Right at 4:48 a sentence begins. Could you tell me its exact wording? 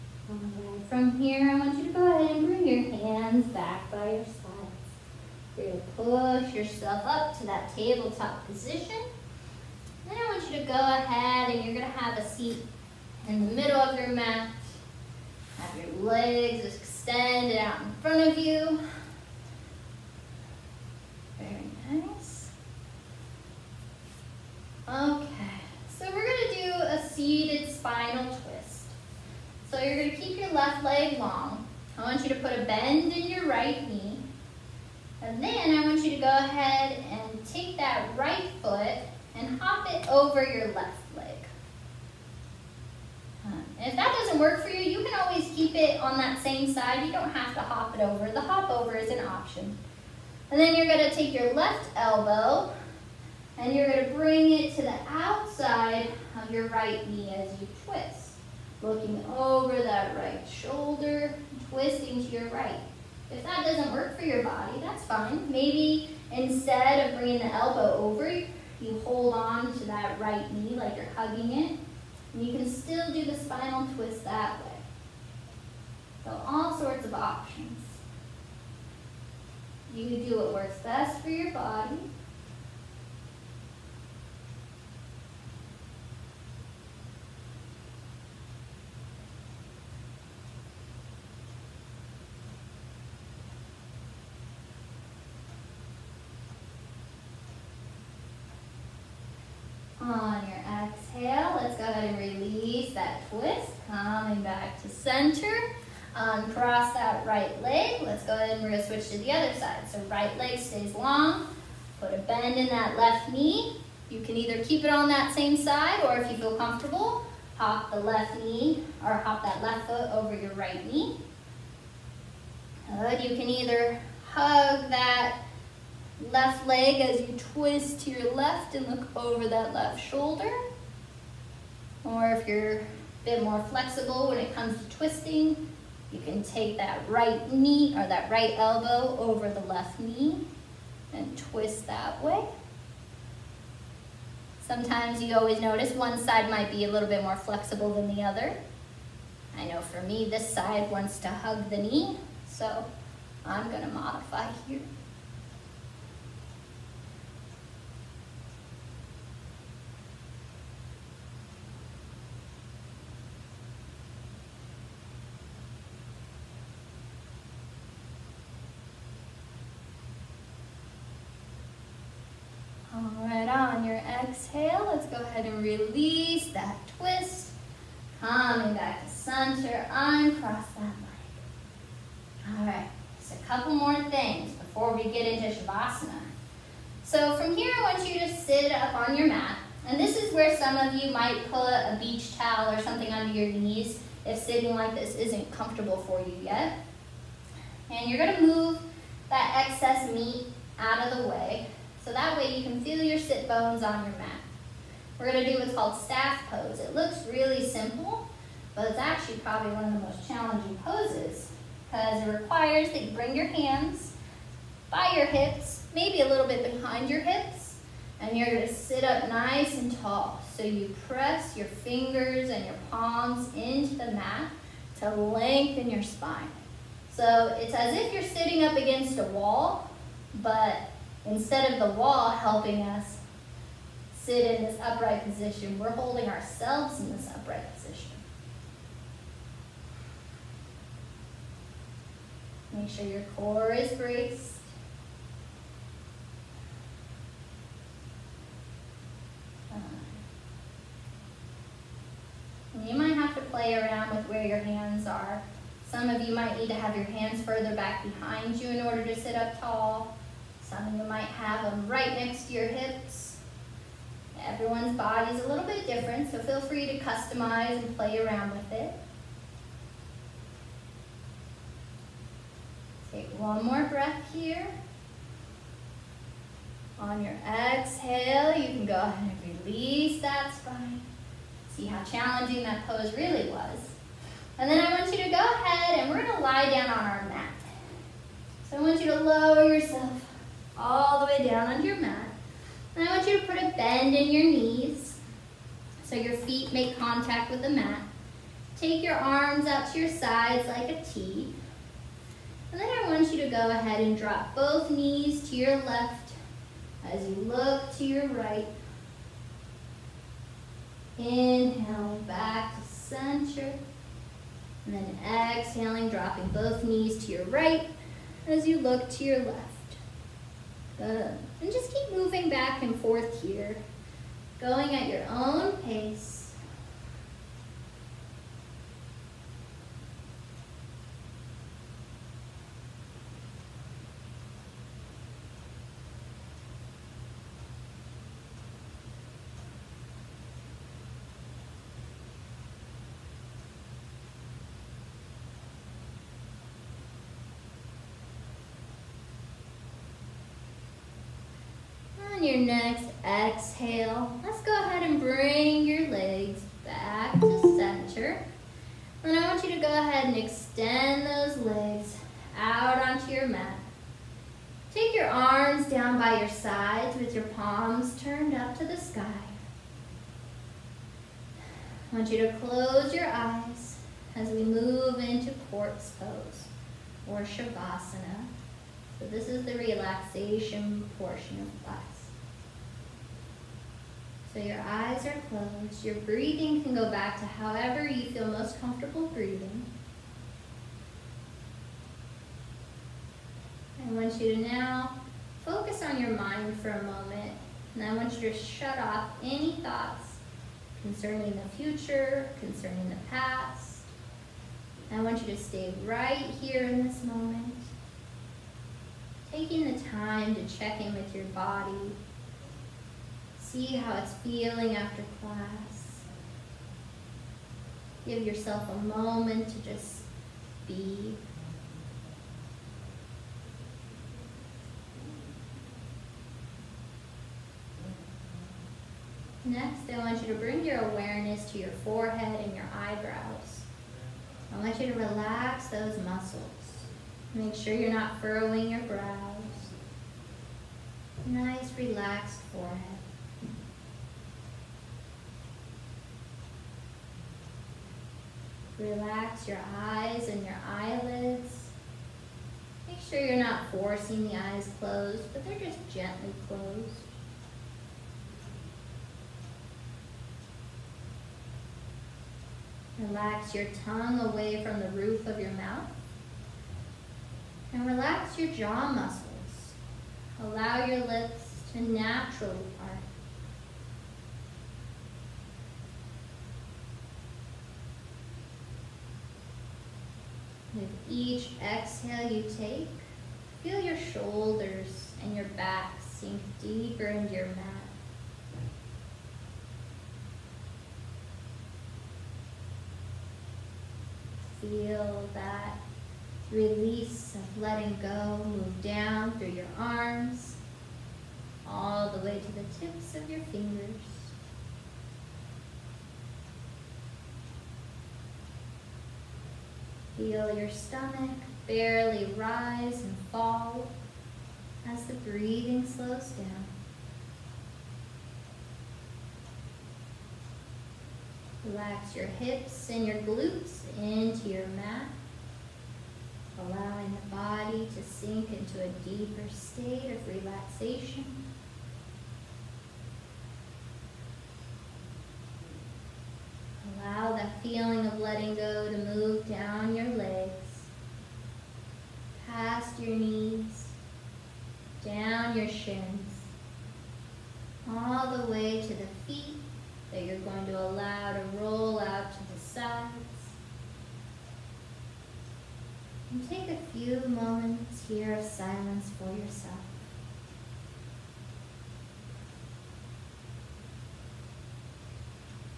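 So I want you to lower yourself all the way down onto your mat.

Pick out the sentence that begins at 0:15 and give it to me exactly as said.
Have your legs extended out in front of you.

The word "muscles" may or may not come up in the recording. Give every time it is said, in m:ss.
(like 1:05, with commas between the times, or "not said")
7:16, 7:49.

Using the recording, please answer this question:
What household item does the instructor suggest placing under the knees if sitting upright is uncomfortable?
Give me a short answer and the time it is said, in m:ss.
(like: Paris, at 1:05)
Beach towel, at 3:12.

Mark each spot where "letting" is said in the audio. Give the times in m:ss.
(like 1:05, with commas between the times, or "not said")
8:17, 8:58.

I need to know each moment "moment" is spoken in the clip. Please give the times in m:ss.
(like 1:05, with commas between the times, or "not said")
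6:37, 6:47, 6:59.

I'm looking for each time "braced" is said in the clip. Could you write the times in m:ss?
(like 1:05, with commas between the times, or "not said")
4:03.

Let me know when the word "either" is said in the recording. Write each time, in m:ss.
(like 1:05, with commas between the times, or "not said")
1:54, 2:03.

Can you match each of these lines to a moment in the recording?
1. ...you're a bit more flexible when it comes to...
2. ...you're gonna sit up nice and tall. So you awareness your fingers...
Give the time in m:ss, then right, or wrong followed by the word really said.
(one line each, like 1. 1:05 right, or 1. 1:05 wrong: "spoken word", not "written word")
1. 2:12 right
2. 3:38 wrong: "press", not "awareness".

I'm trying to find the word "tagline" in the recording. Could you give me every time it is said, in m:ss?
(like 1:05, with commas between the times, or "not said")
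not said.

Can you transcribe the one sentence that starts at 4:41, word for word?
See how challenging that pose really was.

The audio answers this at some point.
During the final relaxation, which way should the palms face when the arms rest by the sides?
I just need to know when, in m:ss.
6:07.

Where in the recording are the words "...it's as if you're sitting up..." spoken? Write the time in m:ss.
3:47.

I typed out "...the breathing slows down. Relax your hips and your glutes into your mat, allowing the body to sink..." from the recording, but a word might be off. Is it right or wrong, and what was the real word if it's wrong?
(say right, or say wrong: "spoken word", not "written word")
right.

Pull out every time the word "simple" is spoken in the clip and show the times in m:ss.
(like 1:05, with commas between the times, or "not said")
3:27.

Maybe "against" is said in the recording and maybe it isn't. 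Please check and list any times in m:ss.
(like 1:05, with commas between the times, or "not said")
3:48.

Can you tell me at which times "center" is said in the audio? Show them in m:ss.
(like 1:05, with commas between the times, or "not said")
1:44, 2:59, 5:12, 5:57.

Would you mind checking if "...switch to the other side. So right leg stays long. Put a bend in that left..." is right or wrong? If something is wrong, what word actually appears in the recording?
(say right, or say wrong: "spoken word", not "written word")
right.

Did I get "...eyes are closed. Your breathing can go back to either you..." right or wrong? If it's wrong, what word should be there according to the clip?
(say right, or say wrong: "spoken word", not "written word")
wrong: "however", not "either".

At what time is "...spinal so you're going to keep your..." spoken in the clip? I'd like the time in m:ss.
0:27.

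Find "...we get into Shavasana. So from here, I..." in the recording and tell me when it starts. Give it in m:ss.
3:04.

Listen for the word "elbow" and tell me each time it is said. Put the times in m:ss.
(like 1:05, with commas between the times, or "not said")
0:51, 1:07, 2:18.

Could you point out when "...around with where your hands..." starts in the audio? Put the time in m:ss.
4:13.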